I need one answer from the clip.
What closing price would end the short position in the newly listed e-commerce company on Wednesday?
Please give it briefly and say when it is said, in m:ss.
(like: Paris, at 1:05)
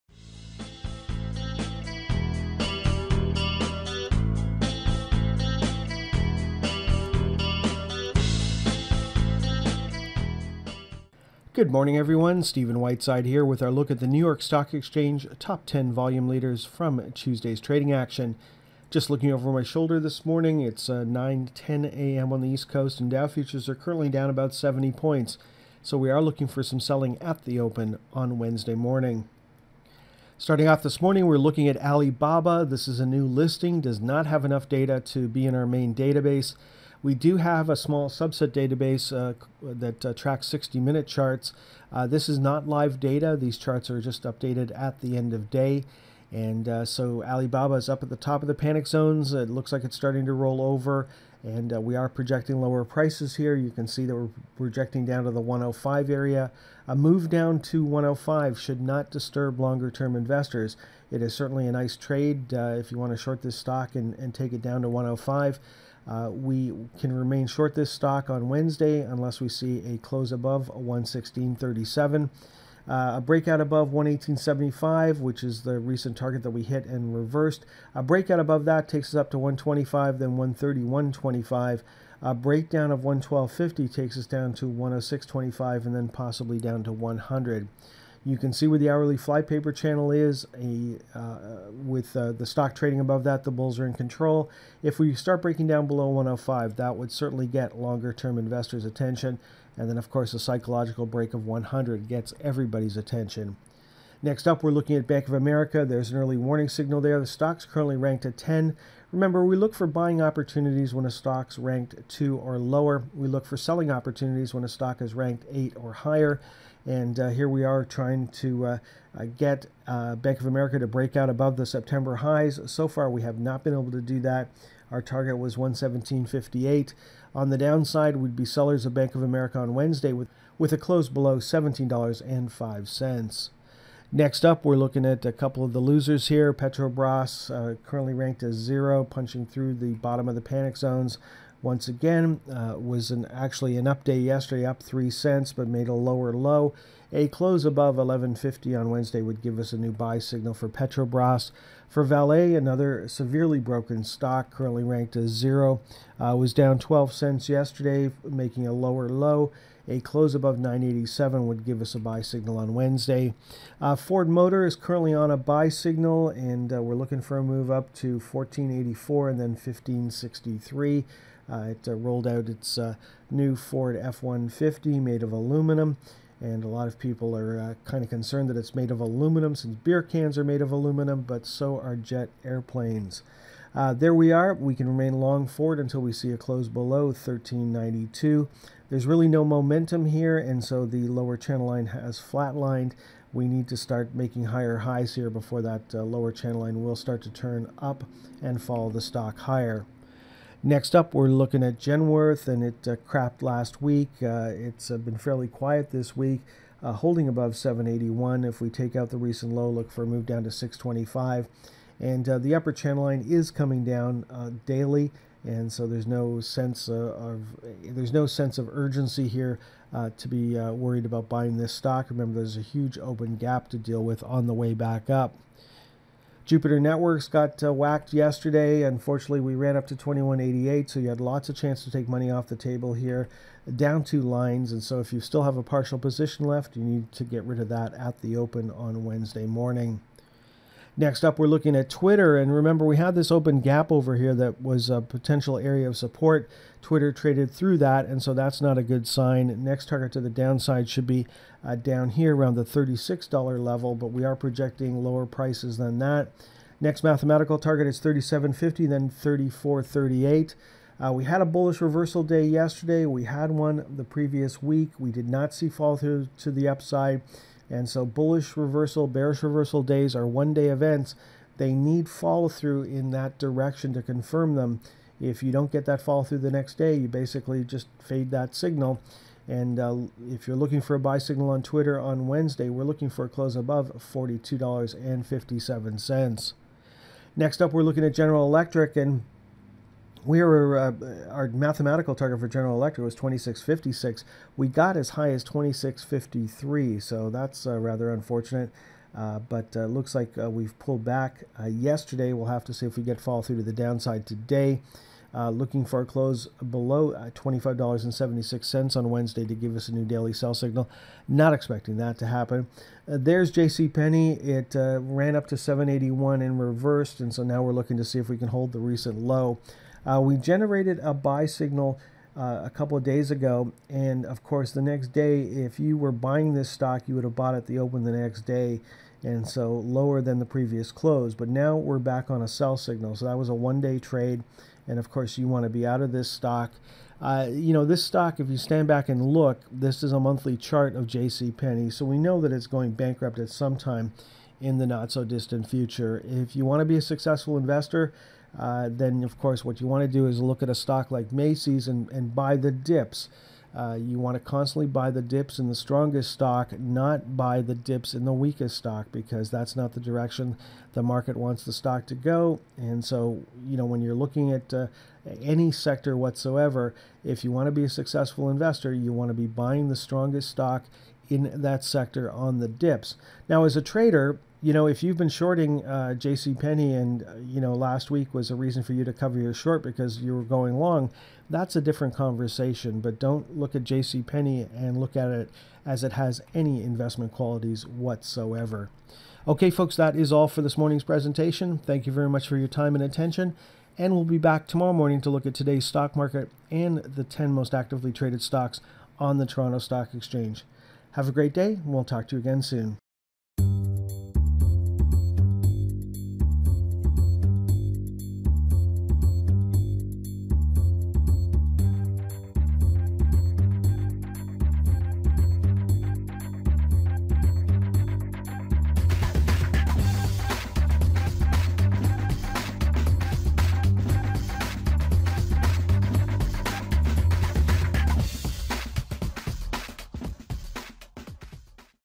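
116.37, at 1:10.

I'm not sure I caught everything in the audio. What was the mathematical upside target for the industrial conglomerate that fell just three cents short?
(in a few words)
26.56.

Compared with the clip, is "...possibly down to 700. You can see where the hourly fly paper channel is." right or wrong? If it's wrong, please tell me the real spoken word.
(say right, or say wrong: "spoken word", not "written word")
wrong: "100", not "700".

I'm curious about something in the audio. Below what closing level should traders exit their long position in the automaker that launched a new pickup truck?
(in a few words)
13.92.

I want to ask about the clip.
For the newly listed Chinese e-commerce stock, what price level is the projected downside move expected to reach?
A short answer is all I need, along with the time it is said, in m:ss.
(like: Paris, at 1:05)
105, at 0:55.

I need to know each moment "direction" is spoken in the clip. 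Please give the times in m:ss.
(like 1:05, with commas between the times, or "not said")
4:33, 6:00.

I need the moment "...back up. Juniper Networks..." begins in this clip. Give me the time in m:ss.
3:44.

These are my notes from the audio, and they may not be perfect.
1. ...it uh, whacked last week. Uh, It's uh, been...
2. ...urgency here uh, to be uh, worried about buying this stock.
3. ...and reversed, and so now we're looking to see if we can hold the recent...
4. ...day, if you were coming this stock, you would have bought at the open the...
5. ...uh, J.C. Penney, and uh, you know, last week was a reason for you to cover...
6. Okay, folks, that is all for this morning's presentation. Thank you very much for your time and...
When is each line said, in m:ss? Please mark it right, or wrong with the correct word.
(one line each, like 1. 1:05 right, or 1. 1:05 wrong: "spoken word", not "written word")
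1. 3:22 wrong: "crapped", not "whacked"
2. 3:38 right
3. 5:16 right
4. 5:25 wrong: "buying", not "coming"
5. 6:15 right
6. 6:29 right.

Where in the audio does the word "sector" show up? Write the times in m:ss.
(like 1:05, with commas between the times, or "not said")
6:05, 6:11.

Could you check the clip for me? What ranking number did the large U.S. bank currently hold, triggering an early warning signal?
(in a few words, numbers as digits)
10.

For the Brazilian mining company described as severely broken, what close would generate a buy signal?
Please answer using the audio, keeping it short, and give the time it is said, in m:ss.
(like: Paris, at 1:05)
9.87, at 2:40.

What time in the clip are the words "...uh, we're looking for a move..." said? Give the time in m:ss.
2:46.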